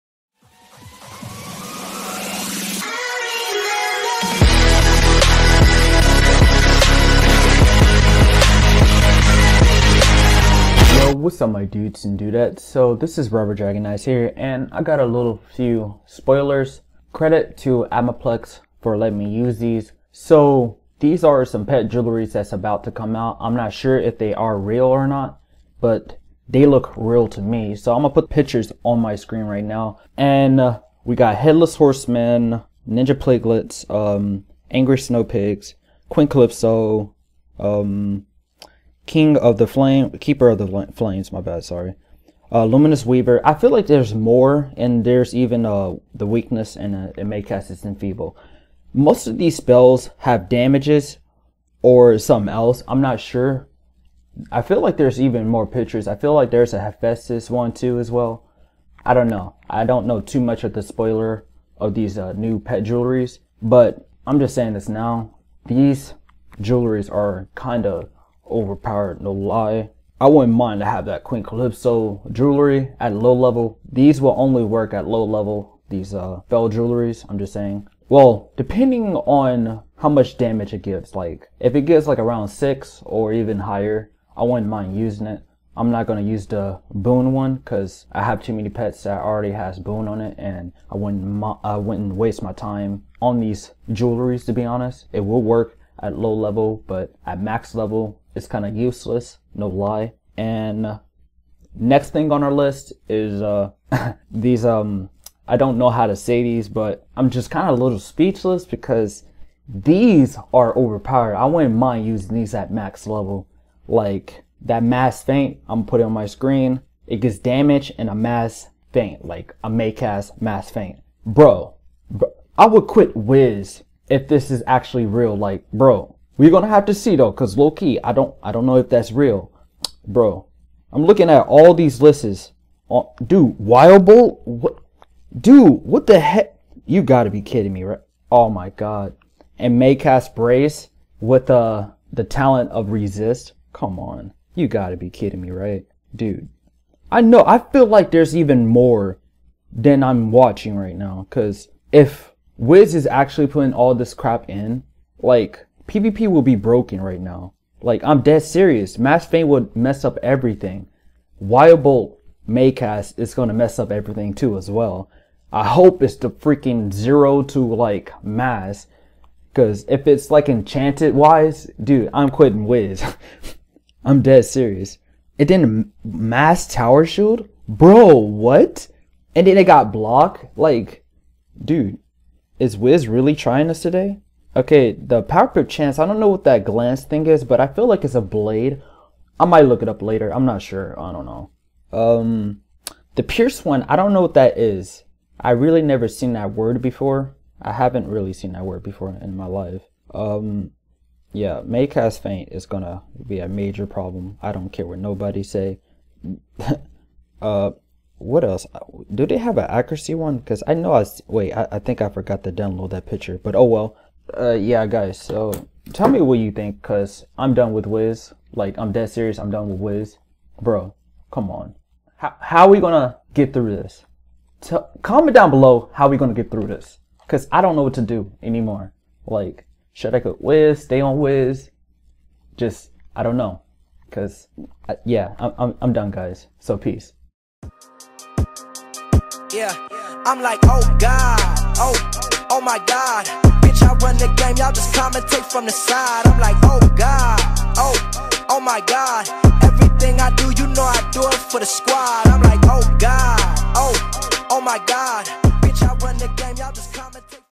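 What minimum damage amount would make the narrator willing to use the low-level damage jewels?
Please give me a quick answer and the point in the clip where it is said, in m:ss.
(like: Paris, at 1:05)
6, at 1:22.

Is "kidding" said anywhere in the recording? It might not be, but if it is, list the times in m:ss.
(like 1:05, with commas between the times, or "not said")
2:17, 2:25.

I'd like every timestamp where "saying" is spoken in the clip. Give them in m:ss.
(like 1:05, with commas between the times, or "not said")
1:04, 1:17.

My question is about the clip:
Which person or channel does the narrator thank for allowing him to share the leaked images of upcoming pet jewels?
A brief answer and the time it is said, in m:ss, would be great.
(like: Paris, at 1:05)
Atmoplex, at 0:17.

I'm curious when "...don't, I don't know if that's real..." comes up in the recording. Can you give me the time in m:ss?
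2:08.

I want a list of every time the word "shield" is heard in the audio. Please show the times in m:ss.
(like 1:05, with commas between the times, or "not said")
2:57.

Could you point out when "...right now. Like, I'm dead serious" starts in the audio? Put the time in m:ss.
2:37.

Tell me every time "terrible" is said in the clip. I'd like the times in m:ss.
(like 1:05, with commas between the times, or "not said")
not said.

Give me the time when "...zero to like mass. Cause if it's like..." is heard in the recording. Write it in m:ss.
2:46.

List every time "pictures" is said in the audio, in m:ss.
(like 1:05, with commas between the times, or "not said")
0:28, 0:55, 3:33.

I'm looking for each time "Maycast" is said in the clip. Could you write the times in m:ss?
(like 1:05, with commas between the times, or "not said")
2:19, 2:42.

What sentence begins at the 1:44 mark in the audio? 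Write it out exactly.
Um, I don't know how to say these, but I'm just kind of a little speechless because these are overpowered.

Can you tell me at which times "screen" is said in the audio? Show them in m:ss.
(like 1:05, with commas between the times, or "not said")
0:29, 1:56.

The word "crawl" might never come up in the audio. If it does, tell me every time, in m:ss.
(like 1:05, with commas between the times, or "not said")
not said.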